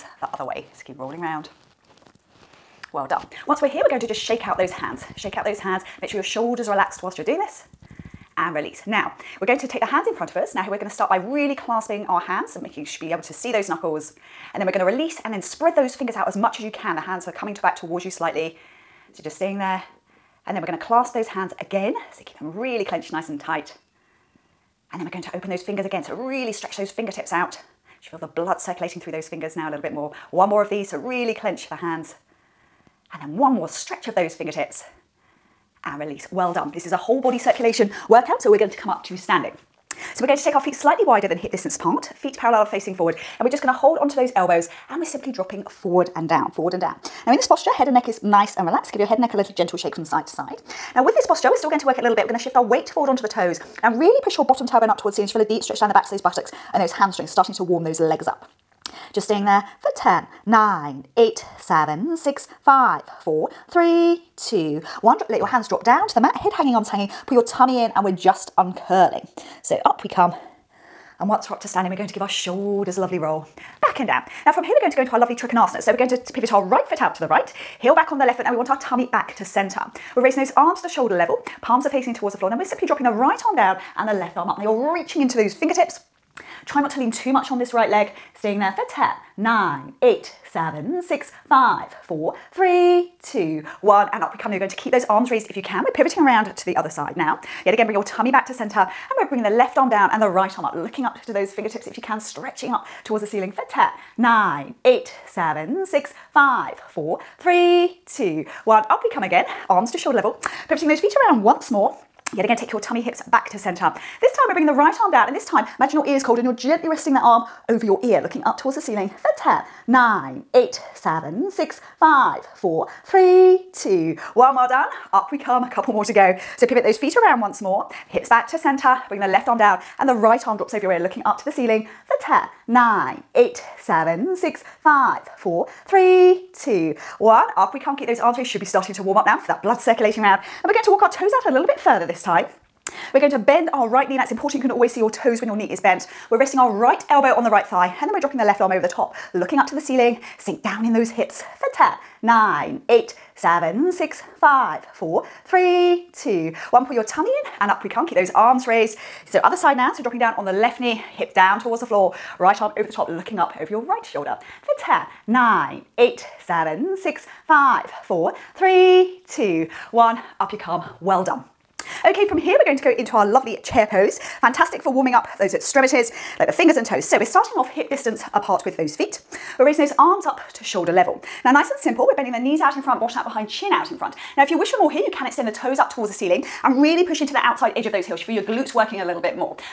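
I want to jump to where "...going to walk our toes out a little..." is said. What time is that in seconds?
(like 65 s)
140 s.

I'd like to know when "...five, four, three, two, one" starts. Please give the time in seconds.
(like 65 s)
106 s.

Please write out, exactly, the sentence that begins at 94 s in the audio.
Now you're going to keep those arms raised if you can.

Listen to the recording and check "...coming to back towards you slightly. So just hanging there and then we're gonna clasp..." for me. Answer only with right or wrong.
wrong.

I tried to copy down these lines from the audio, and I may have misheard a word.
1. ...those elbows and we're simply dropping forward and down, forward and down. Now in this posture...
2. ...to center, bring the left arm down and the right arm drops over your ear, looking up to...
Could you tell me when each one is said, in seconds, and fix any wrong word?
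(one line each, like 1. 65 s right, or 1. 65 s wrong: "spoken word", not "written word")
1. 44 s right
2. 128 s right.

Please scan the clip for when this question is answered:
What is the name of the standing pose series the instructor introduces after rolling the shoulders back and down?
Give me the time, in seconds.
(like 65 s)
75 s.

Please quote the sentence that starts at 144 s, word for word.
You can always see your toes when your knee is bent.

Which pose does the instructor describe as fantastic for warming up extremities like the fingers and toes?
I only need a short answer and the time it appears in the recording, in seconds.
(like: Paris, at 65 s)
chair pose, at 173 s.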